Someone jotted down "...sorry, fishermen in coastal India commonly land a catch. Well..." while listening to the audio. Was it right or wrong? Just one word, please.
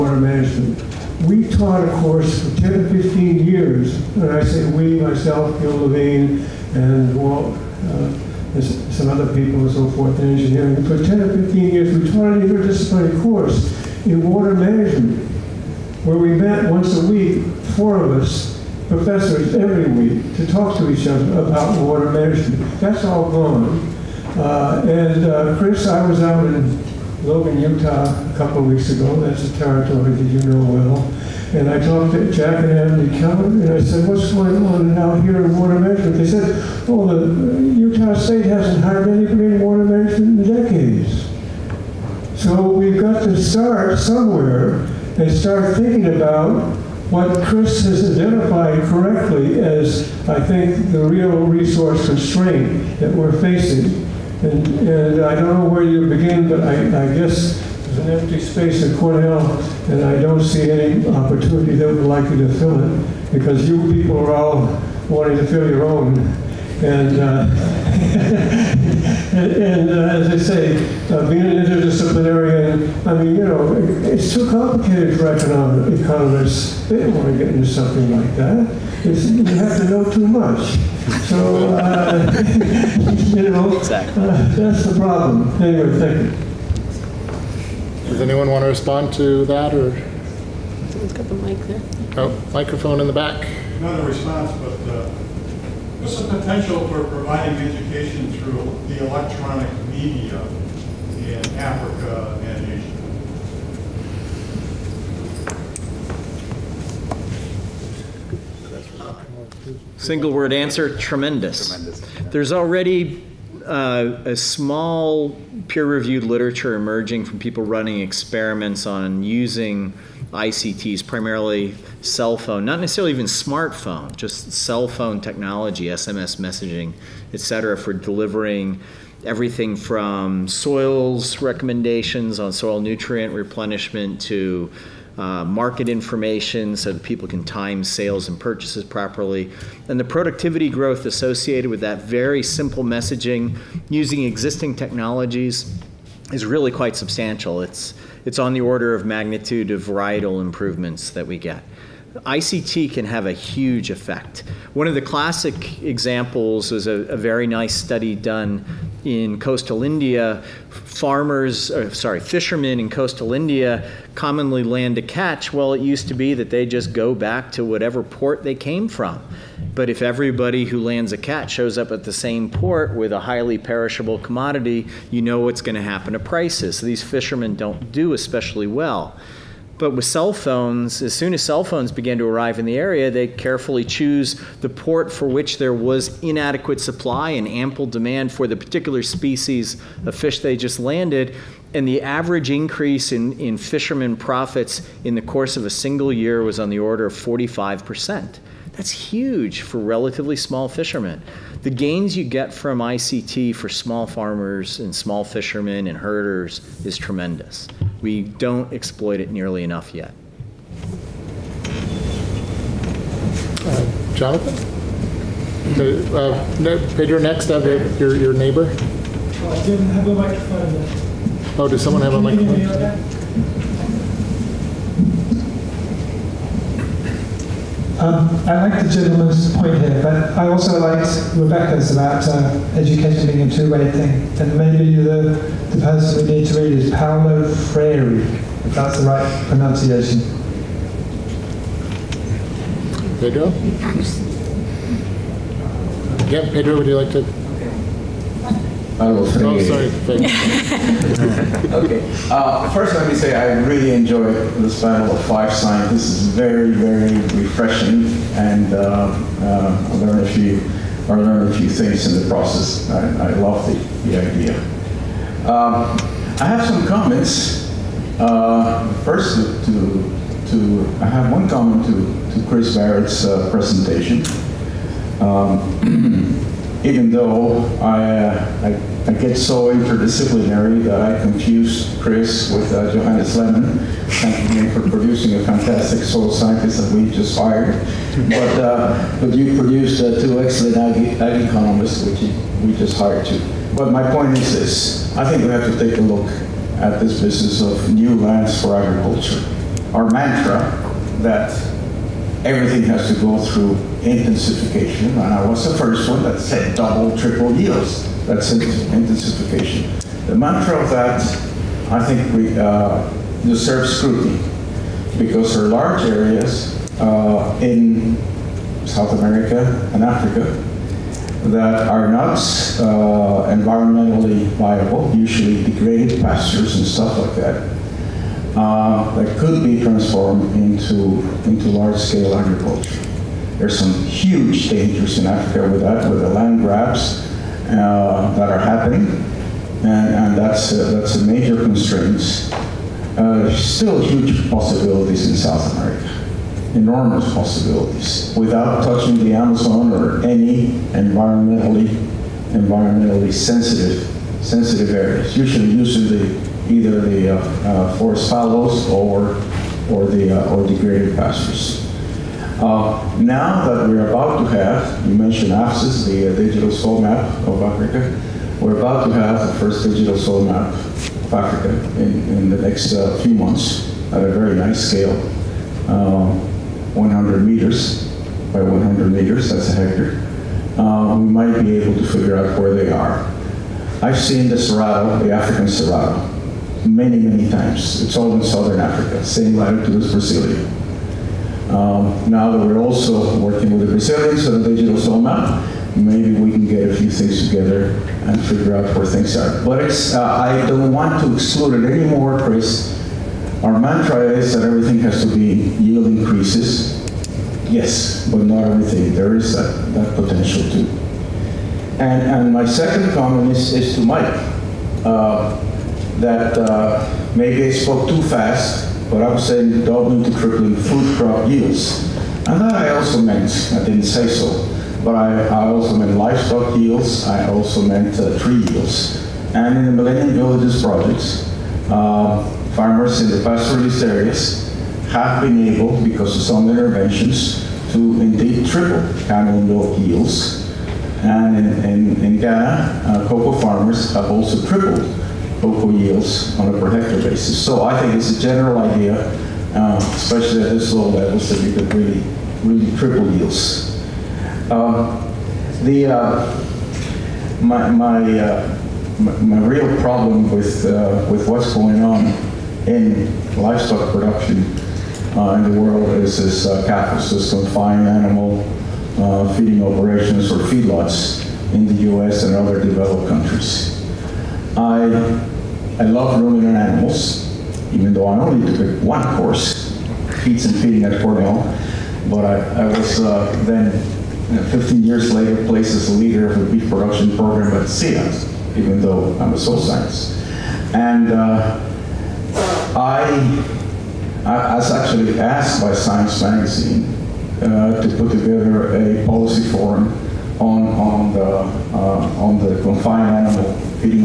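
right.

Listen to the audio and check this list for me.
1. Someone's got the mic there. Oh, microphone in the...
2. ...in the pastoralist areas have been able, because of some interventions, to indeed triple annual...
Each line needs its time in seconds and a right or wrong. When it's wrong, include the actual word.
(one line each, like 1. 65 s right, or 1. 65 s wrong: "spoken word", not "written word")
1. 90 s right
2. 433 s right.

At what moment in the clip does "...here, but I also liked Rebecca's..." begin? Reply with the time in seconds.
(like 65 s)
229 s.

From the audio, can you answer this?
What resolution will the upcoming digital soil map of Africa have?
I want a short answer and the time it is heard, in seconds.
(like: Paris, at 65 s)
100 meters by 100 meters, at 376 s.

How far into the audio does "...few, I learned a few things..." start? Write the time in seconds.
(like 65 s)
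260 s.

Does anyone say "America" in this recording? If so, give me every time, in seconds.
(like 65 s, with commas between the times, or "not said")
319 s, 345 s.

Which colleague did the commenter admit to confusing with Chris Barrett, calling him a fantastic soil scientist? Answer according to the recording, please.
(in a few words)
Johannes Lehmann.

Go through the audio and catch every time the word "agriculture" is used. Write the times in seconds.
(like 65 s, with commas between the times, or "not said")
298 s, 332 s.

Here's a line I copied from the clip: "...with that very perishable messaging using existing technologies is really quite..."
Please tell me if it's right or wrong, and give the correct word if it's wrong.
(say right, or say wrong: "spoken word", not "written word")
wrong: "simple", not "perishable".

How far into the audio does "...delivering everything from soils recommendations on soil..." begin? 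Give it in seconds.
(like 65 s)
127 s.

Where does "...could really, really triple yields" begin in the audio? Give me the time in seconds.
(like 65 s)
451 s.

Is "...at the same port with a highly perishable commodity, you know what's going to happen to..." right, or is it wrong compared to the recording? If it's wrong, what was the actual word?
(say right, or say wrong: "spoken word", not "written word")
right.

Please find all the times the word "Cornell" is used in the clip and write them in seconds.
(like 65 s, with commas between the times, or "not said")
58 s, 481 s.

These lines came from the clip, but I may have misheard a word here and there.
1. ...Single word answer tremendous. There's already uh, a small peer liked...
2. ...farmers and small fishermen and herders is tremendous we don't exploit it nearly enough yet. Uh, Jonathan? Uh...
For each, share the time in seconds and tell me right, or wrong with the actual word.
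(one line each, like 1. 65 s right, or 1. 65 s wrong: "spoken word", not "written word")
1. 110 s wrong: "reviewed", not "liked"
2. 204 s right.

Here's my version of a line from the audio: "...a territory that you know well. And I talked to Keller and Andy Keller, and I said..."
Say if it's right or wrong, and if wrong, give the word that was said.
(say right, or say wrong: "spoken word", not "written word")
wrong: "Jack", not "Keller".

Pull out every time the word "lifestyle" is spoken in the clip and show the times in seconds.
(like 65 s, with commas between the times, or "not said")
not said.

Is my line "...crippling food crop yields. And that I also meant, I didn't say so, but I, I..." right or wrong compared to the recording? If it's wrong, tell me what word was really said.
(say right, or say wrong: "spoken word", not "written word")
right.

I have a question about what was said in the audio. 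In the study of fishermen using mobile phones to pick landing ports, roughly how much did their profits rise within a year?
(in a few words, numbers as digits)
45%.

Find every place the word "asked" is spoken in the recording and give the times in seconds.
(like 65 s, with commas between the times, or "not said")
495 s.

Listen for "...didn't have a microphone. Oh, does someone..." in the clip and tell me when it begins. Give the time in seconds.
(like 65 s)
219 s.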